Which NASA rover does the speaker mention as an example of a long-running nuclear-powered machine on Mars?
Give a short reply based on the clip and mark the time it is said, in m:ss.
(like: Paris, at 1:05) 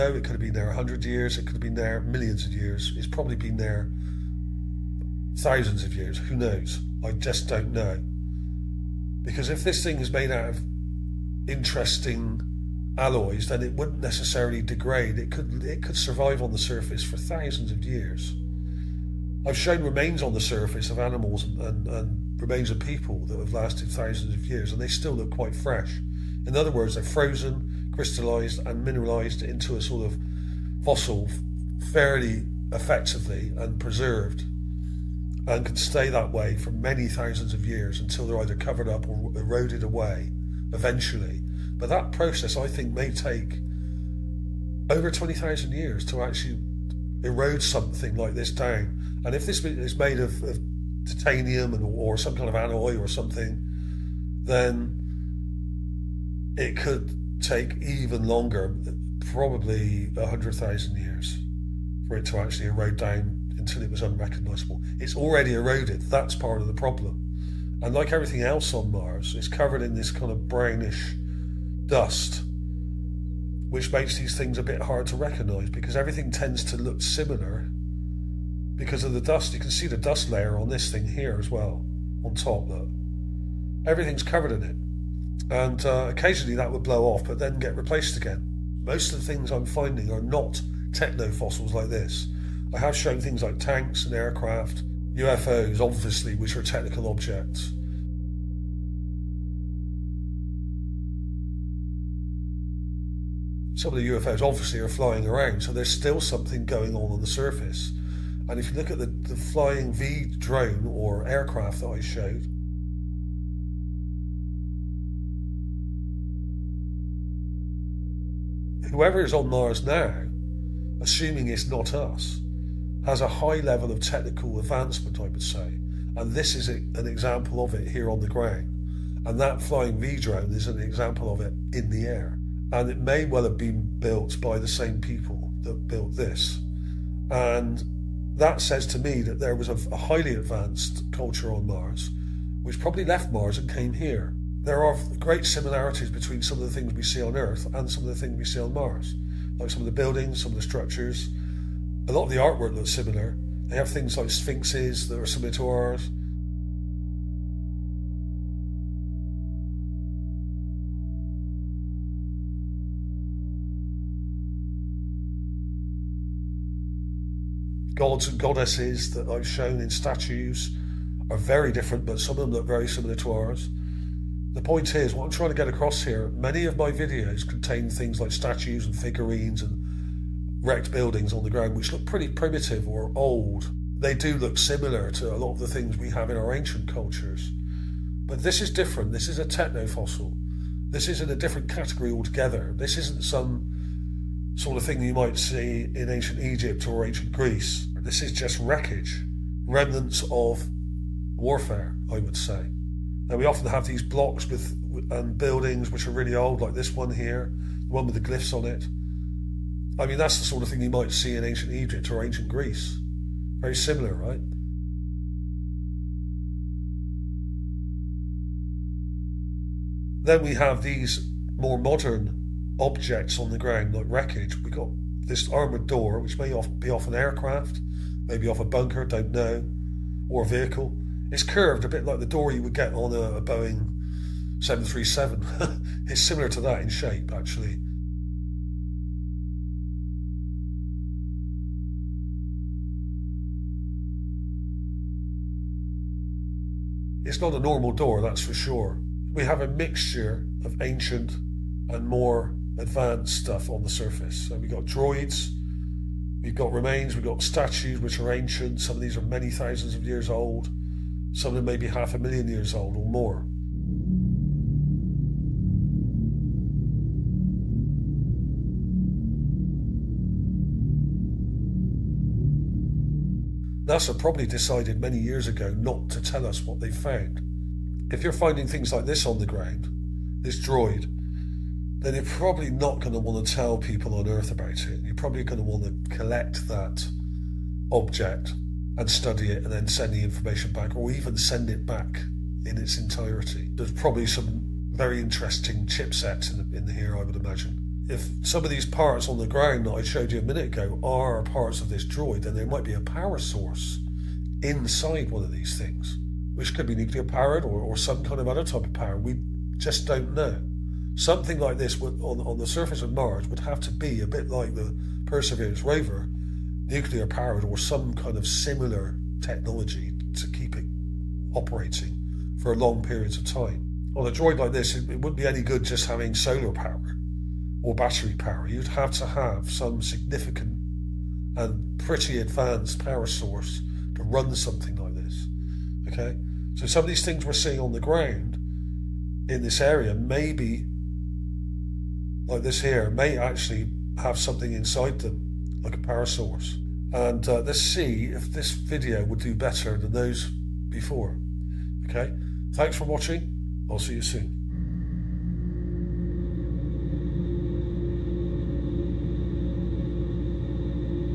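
Perseverance, at 5:15.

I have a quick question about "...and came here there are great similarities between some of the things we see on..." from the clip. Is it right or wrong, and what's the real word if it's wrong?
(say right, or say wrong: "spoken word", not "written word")
right.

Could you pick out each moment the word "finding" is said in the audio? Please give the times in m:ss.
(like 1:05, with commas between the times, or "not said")
1:29, 4:38.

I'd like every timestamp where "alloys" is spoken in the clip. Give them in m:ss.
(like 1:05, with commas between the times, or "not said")
0:12, 0:52.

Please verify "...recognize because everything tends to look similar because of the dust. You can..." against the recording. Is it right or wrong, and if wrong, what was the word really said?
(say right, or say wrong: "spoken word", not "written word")
right.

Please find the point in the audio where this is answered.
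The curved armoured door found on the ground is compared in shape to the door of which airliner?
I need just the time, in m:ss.
3:53.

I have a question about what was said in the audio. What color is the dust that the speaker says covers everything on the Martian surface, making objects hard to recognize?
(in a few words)
brownish.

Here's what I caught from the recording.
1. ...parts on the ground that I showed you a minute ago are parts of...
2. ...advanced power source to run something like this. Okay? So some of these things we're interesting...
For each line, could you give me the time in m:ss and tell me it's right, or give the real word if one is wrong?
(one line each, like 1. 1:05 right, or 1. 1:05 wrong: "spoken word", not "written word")
1. 4:58 right
2. 5:32 wrong: "seeing", not "interesting".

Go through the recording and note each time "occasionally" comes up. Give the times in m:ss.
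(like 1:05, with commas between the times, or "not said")
1:26.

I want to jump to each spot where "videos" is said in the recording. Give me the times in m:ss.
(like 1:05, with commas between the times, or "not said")
2:56, 5:48.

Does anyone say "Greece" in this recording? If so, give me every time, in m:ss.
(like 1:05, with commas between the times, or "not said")
3:17, 3:32.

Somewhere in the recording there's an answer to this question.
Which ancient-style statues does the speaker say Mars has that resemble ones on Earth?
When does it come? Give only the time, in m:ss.
2:34.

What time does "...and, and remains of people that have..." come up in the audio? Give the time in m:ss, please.
0:21.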